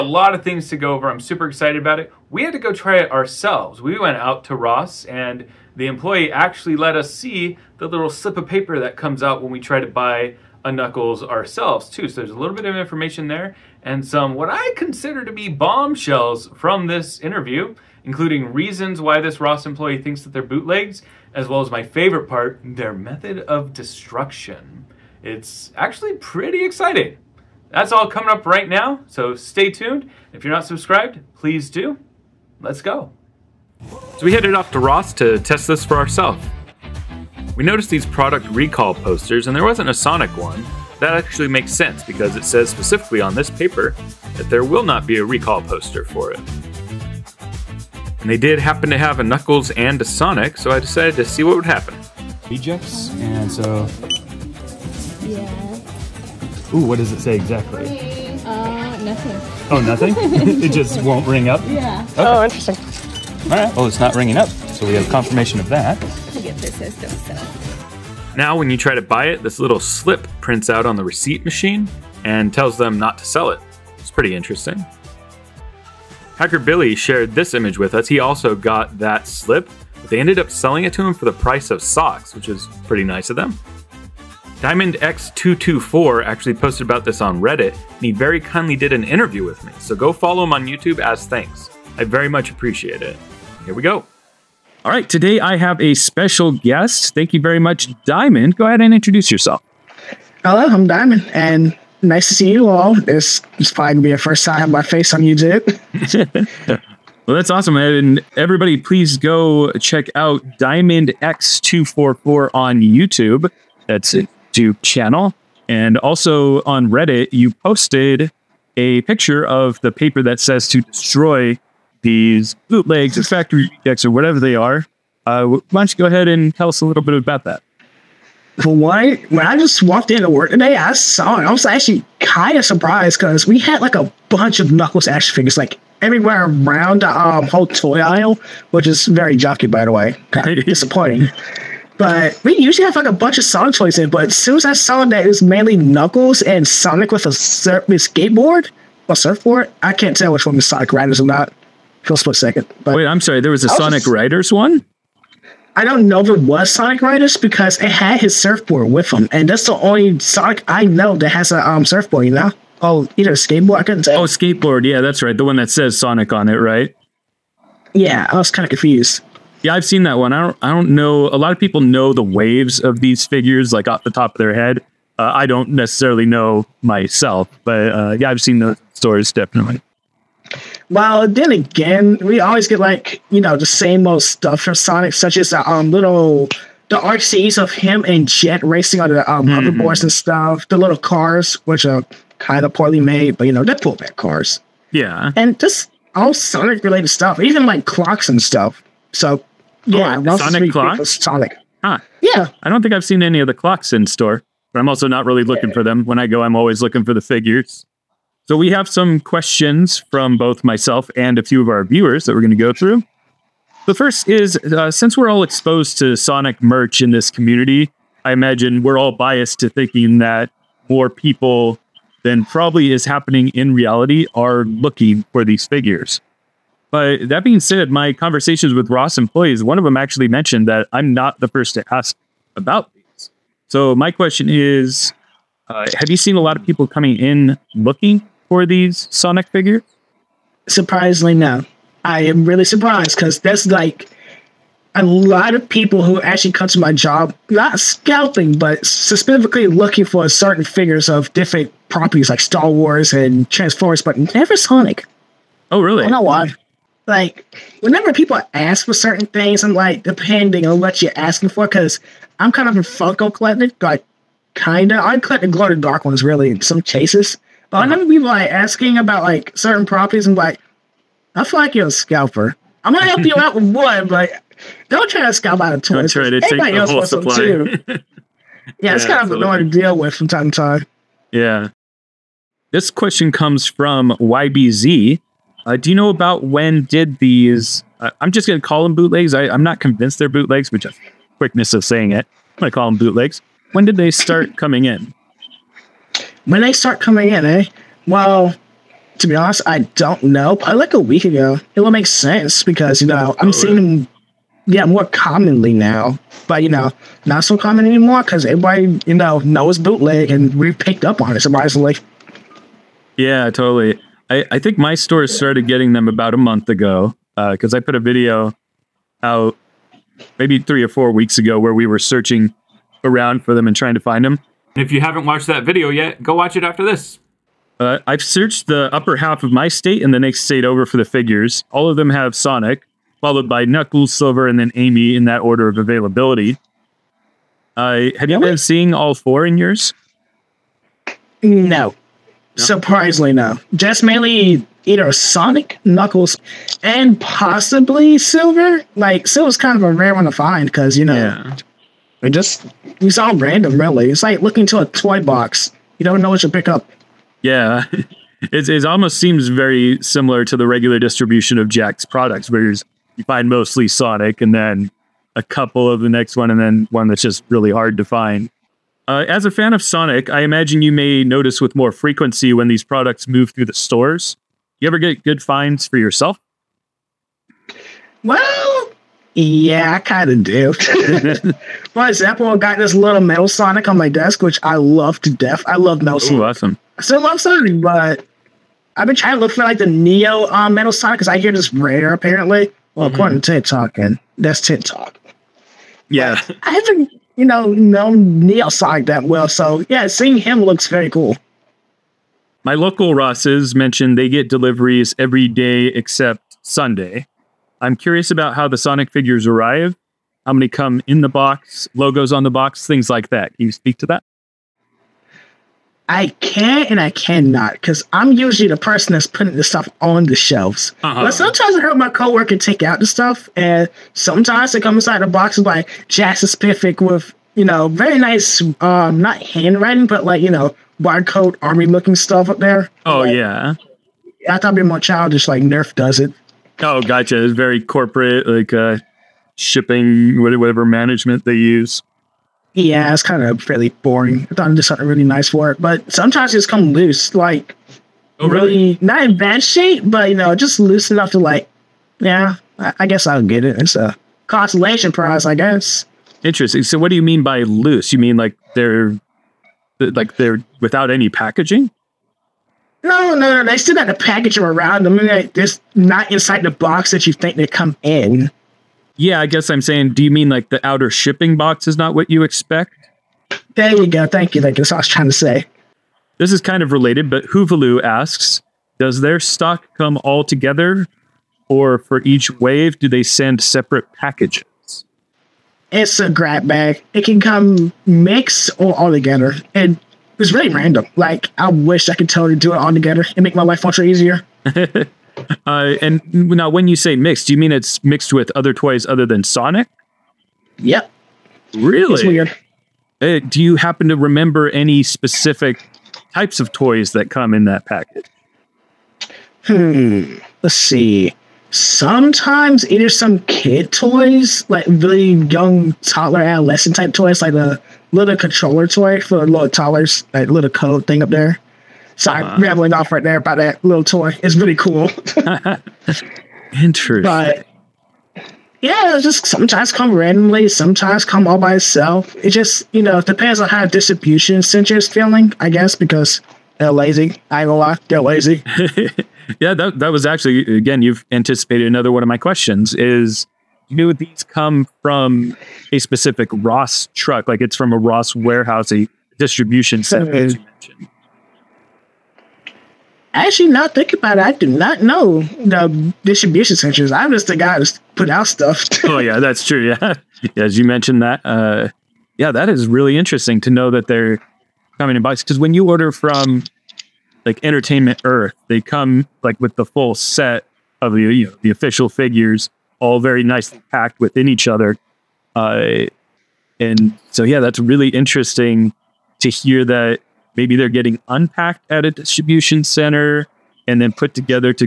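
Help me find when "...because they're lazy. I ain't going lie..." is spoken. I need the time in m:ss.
8:55.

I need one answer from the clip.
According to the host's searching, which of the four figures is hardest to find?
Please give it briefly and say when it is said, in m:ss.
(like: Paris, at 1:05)
Amy, at 5:34.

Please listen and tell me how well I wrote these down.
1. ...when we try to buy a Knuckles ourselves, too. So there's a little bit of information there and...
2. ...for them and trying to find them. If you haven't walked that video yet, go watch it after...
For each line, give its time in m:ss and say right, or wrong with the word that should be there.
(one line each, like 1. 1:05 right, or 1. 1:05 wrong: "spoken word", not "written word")
1. 0:09 right
2. 5:23 wrong: "watched", not "walked".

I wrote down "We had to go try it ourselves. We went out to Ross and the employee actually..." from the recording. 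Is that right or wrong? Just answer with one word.
right.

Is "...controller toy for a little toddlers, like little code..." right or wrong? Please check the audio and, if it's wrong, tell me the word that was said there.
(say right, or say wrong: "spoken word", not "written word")
right.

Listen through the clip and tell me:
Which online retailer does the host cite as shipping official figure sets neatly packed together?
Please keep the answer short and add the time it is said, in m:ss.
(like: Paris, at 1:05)
Entertainment Earth, at 9:27.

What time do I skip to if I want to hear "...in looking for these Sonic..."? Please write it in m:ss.
3:57.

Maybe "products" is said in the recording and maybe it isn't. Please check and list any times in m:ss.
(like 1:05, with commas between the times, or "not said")
0:38, 6:02, 6:12.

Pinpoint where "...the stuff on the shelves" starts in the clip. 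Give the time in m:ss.
6:59.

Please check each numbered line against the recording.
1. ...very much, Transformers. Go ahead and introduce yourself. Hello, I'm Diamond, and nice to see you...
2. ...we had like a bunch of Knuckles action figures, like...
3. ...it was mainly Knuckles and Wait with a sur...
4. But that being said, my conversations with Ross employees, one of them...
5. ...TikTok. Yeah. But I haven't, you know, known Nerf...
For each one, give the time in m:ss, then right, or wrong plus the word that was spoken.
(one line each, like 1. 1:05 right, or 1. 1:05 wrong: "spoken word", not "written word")
1. 1:37 wrong: "Diamond", not "Transformers"
2. 2:13 right
3. 2:25 wrong: "Sonic", not "Wait"
4. 3:46 right
5. 6:34 wrong: "Neo", not "Nerf".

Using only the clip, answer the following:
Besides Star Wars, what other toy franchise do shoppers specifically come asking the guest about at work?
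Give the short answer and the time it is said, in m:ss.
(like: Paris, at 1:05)
Transformers, at 4:13.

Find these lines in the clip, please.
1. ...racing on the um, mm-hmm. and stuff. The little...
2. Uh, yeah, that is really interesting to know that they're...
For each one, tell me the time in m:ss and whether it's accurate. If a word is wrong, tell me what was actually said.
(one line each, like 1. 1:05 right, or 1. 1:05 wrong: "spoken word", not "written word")
1. 3:08 right
2. 9:21 right.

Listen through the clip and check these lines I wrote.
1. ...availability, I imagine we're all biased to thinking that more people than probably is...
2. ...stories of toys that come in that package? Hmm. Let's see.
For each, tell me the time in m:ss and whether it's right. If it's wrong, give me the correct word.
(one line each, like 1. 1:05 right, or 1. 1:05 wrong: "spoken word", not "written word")
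1. 3:37 wrong: "community", not "availability"
2. 8:26 wrong: "types", not "stories".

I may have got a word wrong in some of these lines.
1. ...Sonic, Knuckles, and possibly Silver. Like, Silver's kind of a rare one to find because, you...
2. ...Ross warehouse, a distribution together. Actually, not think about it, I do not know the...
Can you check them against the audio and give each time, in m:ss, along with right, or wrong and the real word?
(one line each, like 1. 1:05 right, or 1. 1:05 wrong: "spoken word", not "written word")
1. 5:45 right
2. 9:07 wrong: "center", not "together".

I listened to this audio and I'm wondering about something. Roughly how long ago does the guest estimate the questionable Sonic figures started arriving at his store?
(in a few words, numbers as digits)
a week ago.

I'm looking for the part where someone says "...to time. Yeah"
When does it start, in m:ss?
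4:40.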